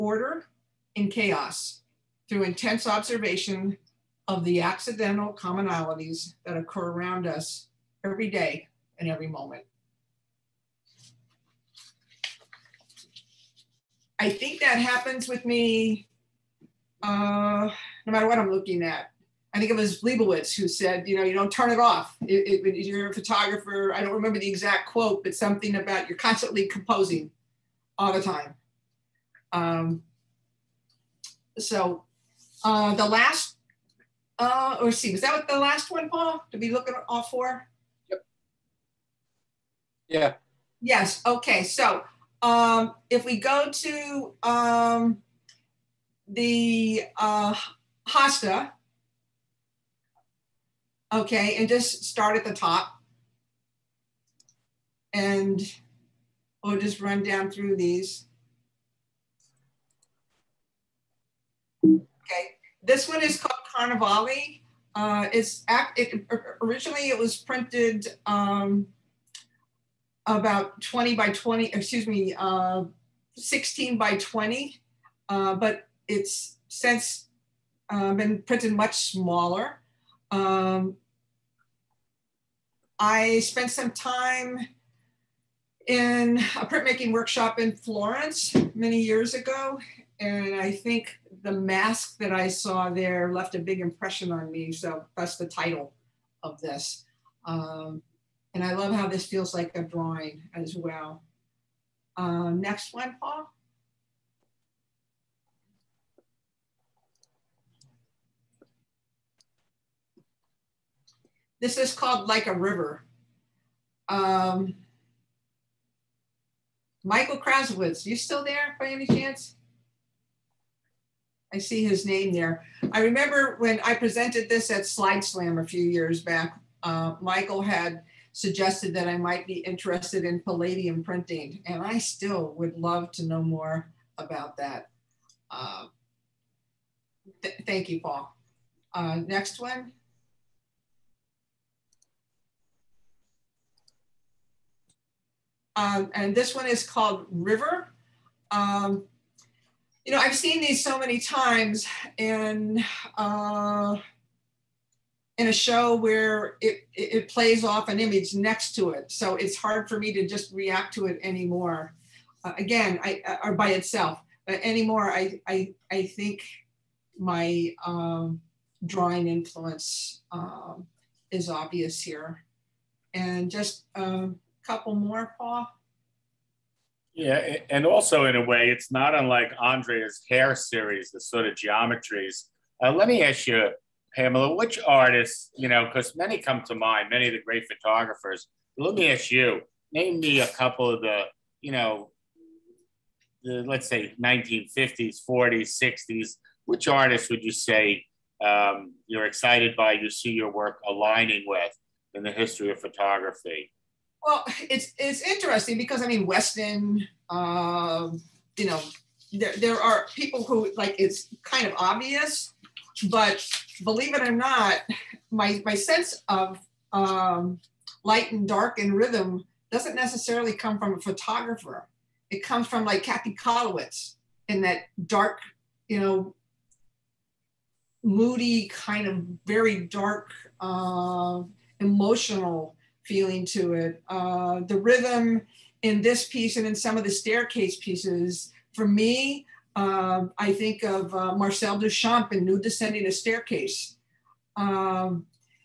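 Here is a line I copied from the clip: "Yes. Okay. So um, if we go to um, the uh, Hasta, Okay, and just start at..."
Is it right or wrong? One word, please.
right.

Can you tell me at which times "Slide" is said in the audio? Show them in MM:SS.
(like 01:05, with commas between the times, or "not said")
02:04.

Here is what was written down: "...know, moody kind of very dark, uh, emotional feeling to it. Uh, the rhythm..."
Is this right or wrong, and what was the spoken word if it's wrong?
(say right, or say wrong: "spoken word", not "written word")
right.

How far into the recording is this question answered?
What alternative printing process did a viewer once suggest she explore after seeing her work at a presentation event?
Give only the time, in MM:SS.
02:10.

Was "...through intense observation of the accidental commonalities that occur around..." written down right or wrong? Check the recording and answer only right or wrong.
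right.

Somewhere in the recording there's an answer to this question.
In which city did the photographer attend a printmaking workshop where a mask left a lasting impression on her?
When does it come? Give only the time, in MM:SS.
01:27.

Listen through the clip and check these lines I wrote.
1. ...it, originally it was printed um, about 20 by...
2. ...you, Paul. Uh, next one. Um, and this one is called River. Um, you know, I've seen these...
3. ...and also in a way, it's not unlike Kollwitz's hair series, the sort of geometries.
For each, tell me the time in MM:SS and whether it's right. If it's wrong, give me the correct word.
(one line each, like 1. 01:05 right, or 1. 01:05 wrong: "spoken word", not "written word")
1. 01:05 right
2. 02:17 right
3. 02:57 wrong: "Andrea", not "Kollwitz".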